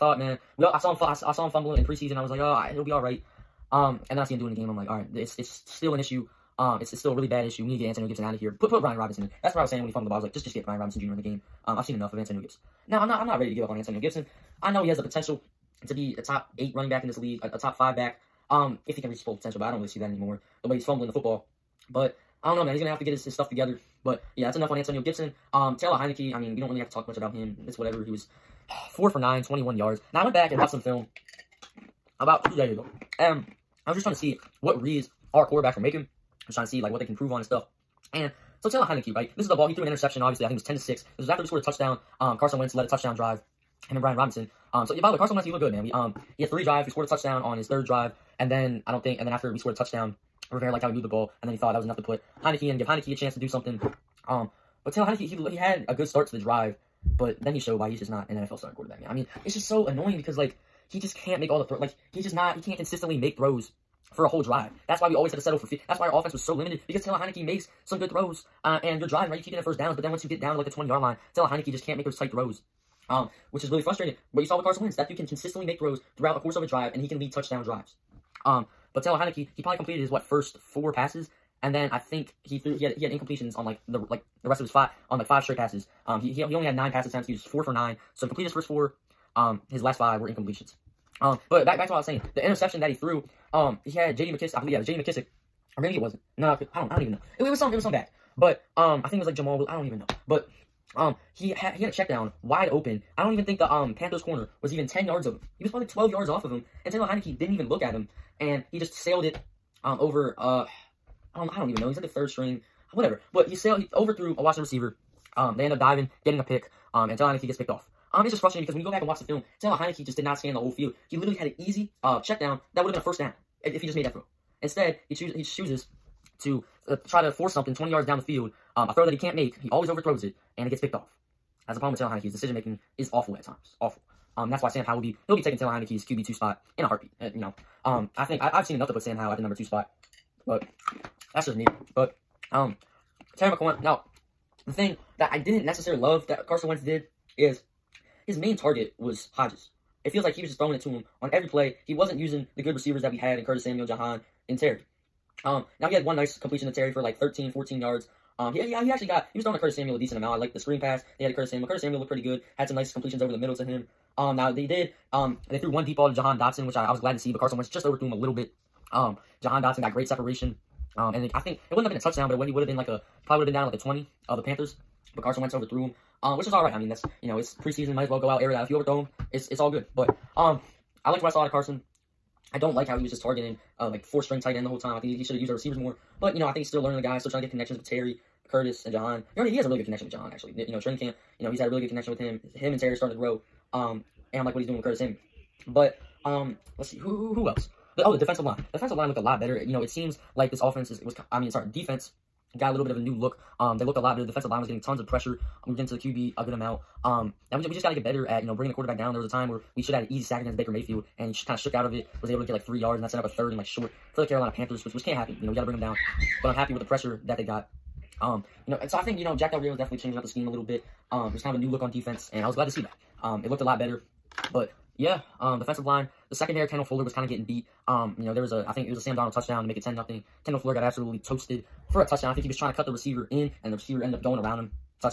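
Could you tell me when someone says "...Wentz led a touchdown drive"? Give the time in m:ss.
0:42.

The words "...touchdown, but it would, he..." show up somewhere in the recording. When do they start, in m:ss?
2:52.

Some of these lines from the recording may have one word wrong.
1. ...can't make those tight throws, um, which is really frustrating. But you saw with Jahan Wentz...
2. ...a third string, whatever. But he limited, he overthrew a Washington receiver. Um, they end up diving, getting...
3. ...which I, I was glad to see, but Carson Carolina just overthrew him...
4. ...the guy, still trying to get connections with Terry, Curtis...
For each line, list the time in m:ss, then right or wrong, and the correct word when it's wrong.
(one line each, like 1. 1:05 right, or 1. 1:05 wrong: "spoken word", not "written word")
1. 1:11 wrong: "Carson", not "Jahan"
2. 1:52 wrong: "sailed", not "limited"
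3. 2:46 wrong: "Wentz", not "Carolina"
4. 3:06 right.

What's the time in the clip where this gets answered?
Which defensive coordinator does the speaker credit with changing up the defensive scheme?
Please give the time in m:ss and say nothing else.
3:39.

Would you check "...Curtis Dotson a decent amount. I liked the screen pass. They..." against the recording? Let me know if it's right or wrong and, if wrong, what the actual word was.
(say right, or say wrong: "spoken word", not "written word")
wrong: "Samuel", not "Dotson".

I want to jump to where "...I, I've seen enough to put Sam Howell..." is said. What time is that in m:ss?
2:18.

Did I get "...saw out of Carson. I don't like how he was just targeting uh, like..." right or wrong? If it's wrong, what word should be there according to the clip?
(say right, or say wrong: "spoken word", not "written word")
right.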